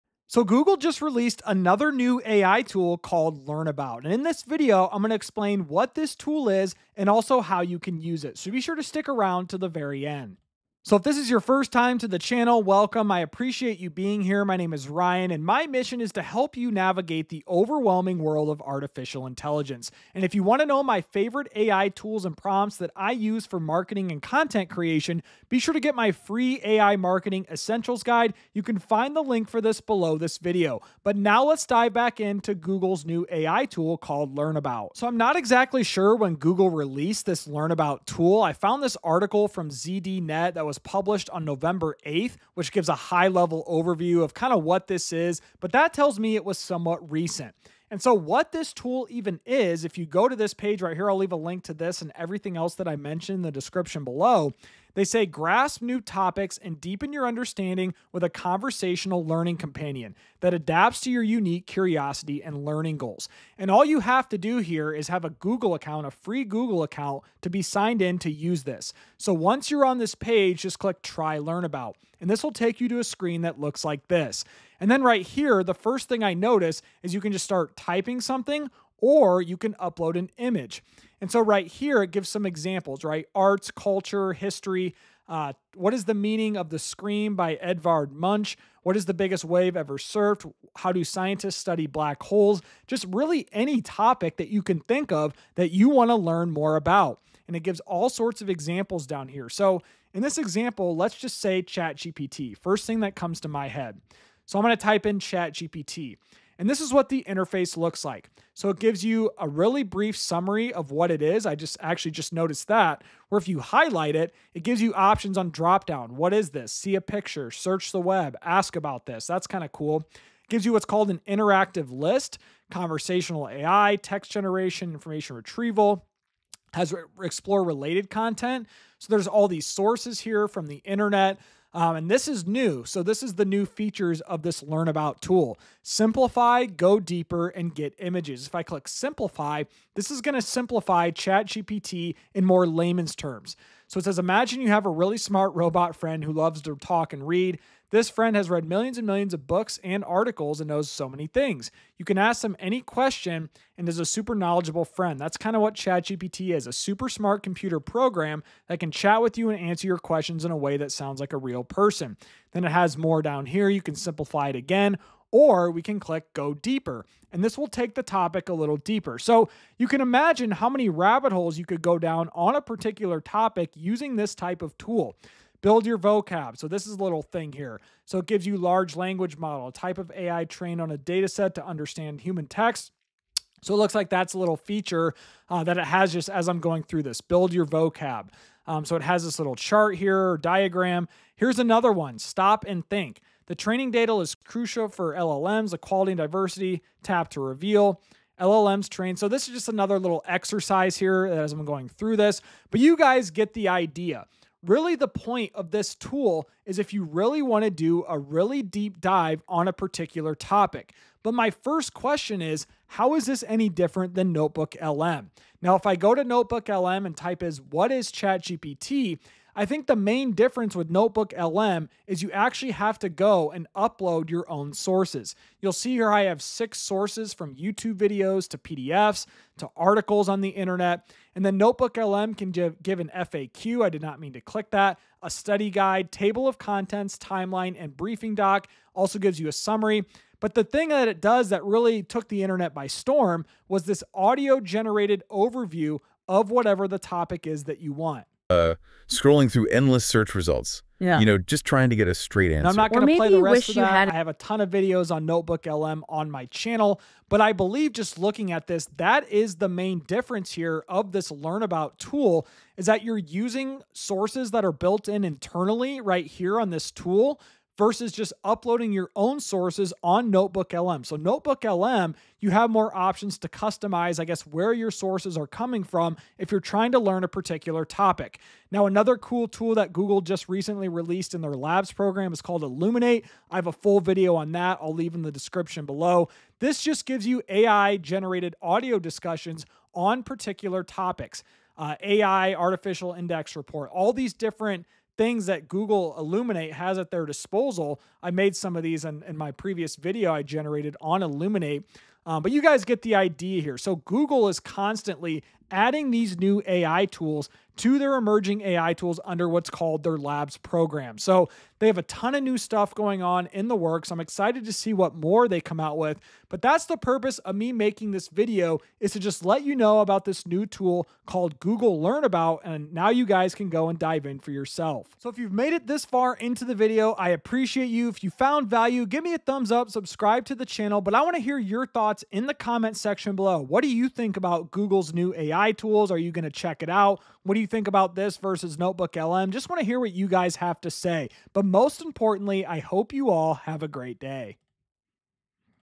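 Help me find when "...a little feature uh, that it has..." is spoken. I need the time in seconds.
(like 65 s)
184 s.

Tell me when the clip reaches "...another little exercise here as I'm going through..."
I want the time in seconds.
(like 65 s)
199 s.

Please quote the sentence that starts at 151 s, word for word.
You can ask them any question and is a super knowledgeable friend.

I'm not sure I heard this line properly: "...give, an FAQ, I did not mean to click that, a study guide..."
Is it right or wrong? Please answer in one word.
right.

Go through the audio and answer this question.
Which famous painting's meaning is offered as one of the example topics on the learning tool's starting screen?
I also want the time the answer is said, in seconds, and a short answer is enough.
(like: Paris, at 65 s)
The Scream, at 86 s.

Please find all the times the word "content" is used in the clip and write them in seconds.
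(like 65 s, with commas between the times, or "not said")
24 s, 128 s, 236 s.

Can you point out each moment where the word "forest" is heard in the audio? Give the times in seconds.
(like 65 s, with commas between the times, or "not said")
not said.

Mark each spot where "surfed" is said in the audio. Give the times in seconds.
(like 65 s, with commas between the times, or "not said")
89 s.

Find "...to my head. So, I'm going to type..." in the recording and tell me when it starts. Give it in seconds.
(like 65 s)
103 s.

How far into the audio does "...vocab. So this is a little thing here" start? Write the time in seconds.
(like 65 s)
175 s.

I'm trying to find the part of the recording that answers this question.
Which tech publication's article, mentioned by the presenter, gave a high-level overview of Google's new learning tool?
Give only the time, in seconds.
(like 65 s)
39 s.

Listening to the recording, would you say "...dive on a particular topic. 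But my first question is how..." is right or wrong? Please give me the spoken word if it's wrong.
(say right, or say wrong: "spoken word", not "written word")
right.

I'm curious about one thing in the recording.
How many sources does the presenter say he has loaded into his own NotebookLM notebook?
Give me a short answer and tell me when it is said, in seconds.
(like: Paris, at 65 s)
6, at 226 s.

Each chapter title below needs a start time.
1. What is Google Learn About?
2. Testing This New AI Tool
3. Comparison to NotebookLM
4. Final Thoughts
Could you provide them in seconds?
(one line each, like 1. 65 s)
1. 48 s
2. 100 s
3. 211 s
4. 304 s.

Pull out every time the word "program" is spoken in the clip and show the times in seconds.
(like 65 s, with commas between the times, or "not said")
157 s, 281 s, 310 s.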